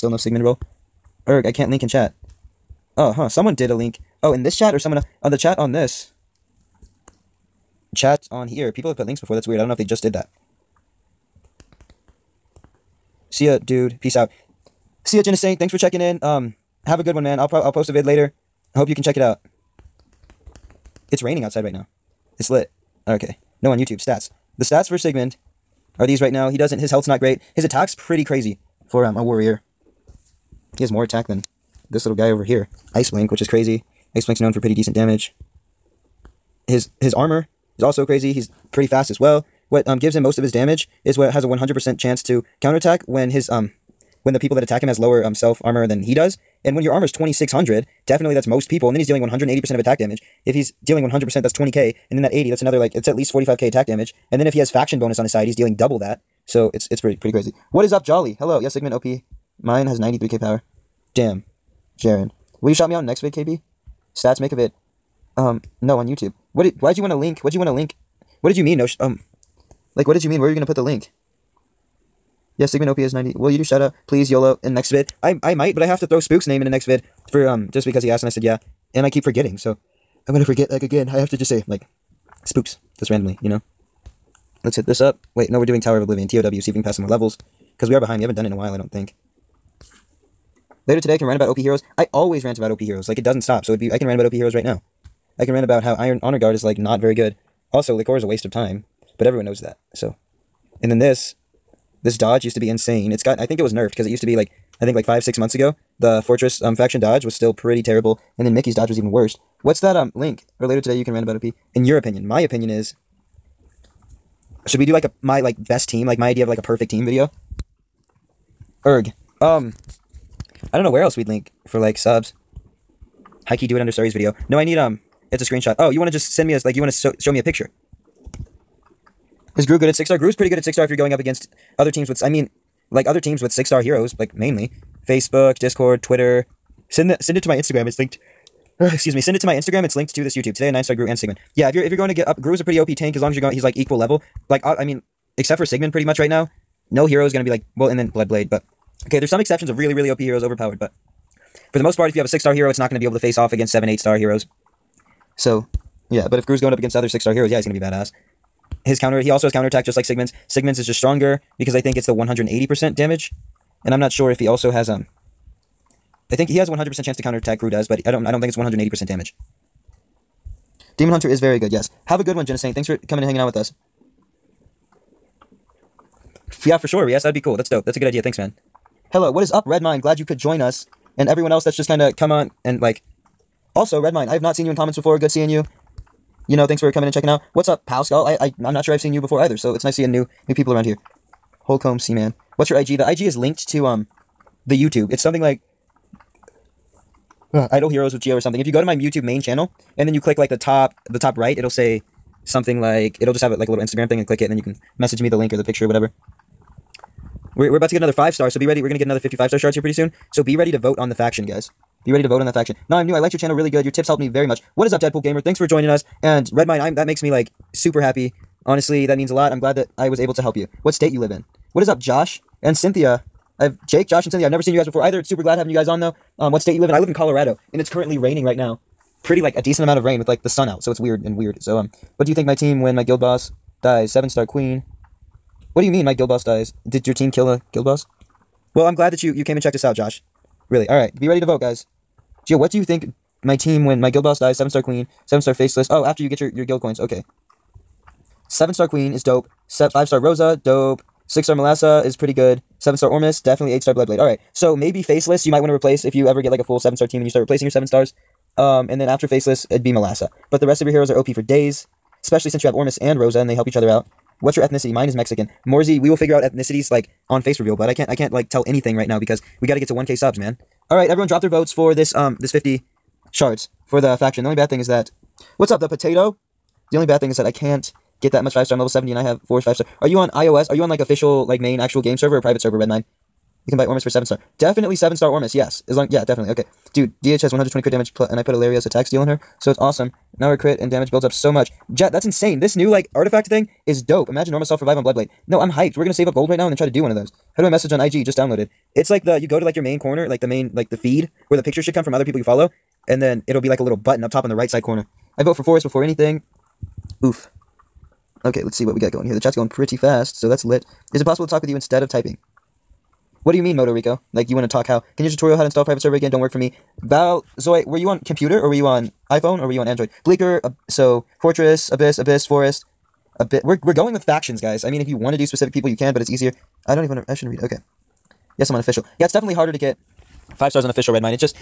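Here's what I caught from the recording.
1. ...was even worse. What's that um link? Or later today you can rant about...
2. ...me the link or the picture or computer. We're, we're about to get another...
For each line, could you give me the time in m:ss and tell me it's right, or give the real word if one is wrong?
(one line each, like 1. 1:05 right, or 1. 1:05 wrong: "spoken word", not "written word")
1. 1:48 right
2. 3:25 wrong: "whatever", not "computer".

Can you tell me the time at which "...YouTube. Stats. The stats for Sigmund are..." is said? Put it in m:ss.
0:23.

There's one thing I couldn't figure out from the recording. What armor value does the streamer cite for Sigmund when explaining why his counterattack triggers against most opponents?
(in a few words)
2600.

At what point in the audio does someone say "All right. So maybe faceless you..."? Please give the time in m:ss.
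4:14.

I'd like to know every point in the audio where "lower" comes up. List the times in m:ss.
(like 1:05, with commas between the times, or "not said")
0:44.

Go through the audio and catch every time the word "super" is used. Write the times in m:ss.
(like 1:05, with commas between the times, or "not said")
3:37, 3:45.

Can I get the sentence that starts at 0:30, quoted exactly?
He has more attack than this little guy over here.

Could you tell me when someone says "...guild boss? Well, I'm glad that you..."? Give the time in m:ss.
3:57.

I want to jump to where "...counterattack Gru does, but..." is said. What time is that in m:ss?
2:47.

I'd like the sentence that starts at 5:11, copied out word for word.
Is it possible to talk with you instead of typing?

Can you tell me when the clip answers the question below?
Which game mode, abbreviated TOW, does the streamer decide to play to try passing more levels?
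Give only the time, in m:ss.
1:25.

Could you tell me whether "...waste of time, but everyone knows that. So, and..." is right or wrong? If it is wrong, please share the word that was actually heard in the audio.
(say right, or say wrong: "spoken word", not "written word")
right.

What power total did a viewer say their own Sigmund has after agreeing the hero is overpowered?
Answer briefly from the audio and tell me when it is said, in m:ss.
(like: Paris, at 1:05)
93k, at 0:59.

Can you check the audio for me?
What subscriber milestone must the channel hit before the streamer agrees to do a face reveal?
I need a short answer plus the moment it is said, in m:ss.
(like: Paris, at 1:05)
1k subs, at 4:29.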